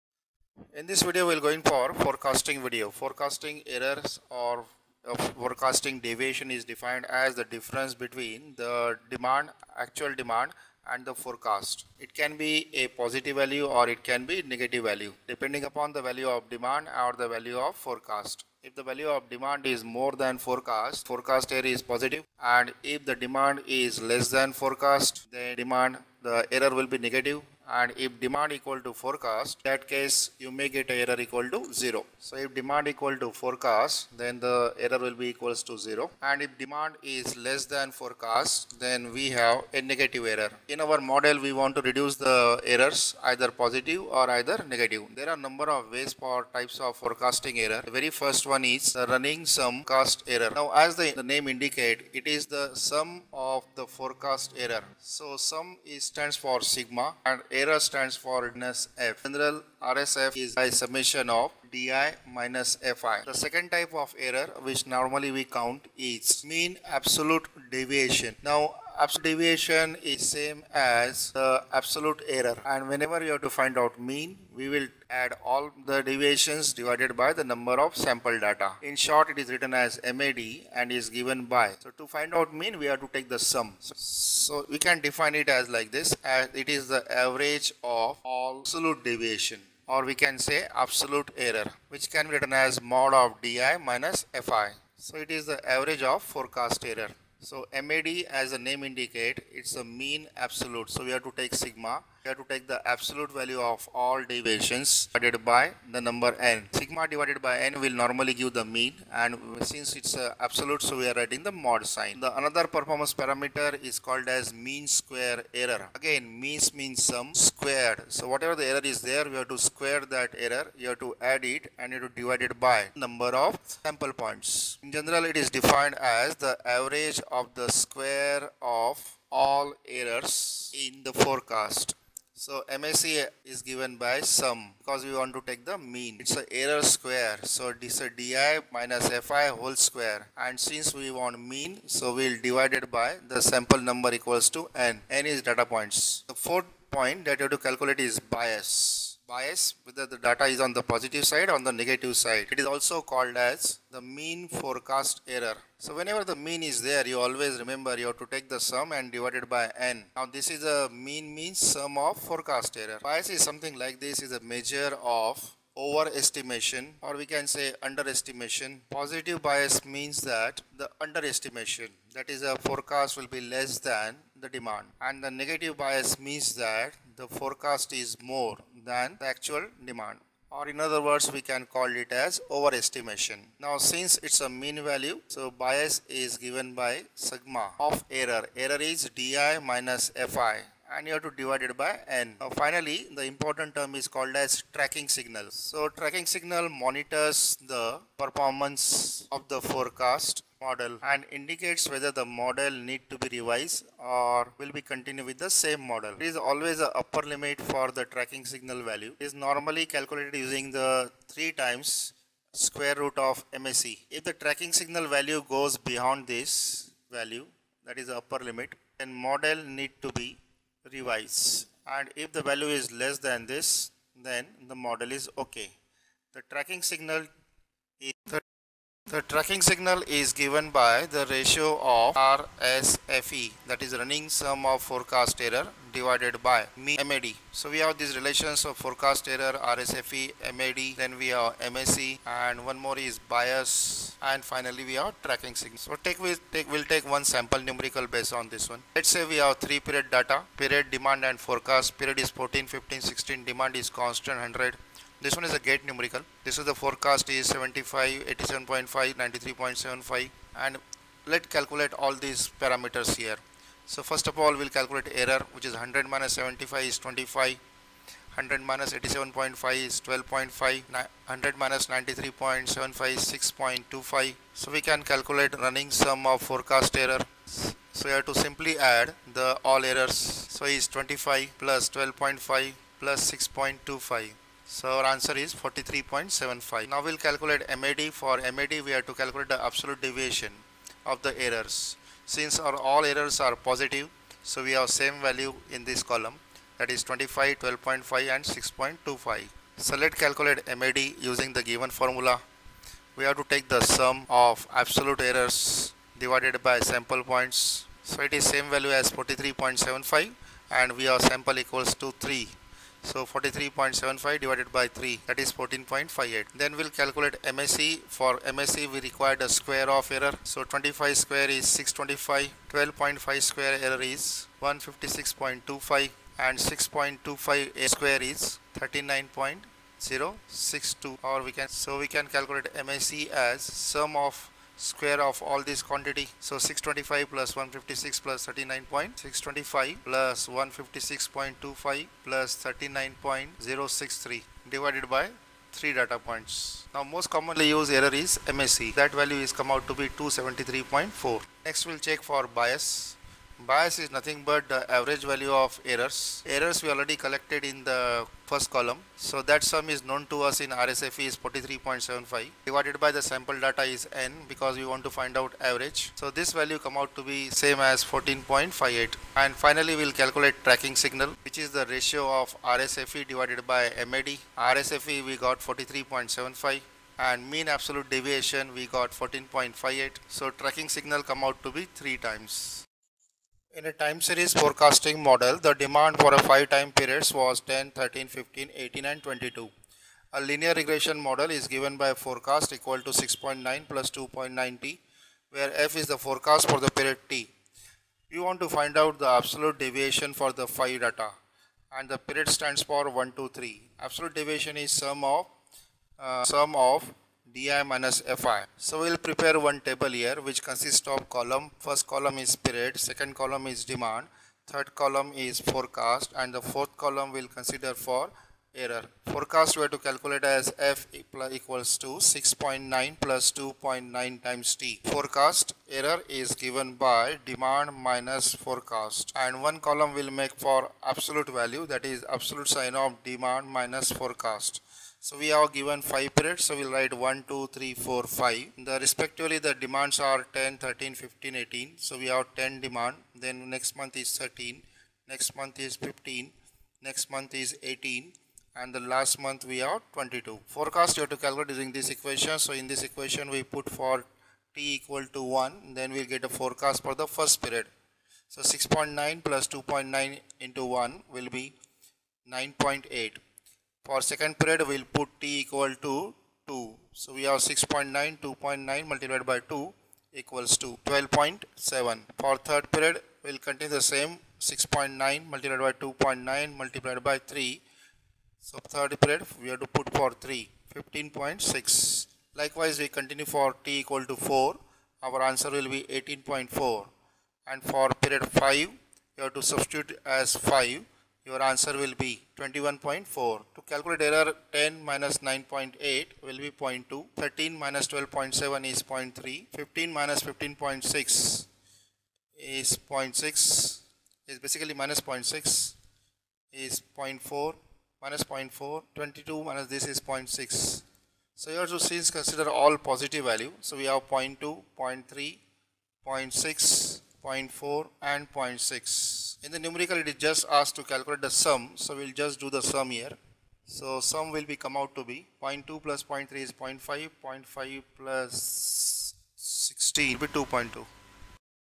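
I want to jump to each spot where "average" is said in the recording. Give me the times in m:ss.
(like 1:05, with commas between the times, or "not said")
1:27, 1:35, 2:06, 5:54, 6:05.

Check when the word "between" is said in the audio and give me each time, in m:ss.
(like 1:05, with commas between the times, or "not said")
0:07.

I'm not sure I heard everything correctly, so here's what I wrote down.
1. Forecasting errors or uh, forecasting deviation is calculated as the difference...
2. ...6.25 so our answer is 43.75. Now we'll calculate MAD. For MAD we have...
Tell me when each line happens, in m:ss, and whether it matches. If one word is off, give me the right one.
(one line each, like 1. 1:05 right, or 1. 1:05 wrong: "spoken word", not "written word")
1. 0:02 wrong: "defined", not "calculated"
2. 4:43 right.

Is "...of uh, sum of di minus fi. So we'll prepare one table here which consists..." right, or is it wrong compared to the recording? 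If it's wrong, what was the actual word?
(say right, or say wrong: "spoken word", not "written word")
right.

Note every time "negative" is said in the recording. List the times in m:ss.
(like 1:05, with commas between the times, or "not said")
0:14, 0:26, 0:39, 0:44, 2:31, 2:55.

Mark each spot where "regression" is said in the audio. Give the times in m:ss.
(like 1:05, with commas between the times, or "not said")
6:30.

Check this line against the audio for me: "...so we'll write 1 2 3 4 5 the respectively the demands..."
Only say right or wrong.
right.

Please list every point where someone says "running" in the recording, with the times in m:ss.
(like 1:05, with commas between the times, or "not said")
0:49, 3:54, 4:35.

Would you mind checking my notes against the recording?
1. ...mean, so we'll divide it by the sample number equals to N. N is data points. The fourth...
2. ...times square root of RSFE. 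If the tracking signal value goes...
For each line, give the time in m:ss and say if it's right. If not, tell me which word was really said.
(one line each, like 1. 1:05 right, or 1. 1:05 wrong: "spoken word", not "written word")
1. 2:21 right
2. 3:31 wrong: "MSE", not "RSFE".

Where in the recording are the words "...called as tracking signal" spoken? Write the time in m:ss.
3:14.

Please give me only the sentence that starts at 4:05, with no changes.
So take, we'll, take, we'll take one sample numerical based on this one.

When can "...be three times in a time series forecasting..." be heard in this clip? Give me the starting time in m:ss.
6:21.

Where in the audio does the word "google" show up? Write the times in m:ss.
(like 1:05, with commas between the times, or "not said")
not said.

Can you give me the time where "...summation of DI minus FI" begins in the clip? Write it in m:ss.
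1:00.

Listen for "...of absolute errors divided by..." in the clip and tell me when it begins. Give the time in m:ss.
5:04.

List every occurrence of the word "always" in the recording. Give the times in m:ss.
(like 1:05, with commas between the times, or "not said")
2:37, 3:26.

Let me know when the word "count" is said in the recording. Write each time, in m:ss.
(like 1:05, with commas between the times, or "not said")
1:05.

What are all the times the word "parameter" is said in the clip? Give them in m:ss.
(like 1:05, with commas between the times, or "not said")
1:53, 4:22.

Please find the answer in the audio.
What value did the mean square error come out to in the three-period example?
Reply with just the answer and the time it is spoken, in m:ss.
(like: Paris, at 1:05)
273.4, at 5:50.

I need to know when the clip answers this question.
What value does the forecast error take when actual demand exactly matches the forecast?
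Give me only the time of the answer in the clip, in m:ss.
0:30.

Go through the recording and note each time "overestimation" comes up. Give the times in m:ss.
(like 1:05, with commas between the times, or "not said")
2:45, 3:02.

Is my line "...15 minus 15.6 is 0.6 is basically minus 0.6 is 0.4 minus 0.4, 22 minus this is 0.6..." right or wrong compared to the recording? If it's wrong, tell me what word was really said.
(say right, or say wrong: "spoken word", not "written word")
right.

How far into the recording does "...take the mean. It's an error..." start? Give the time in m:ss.
2:15.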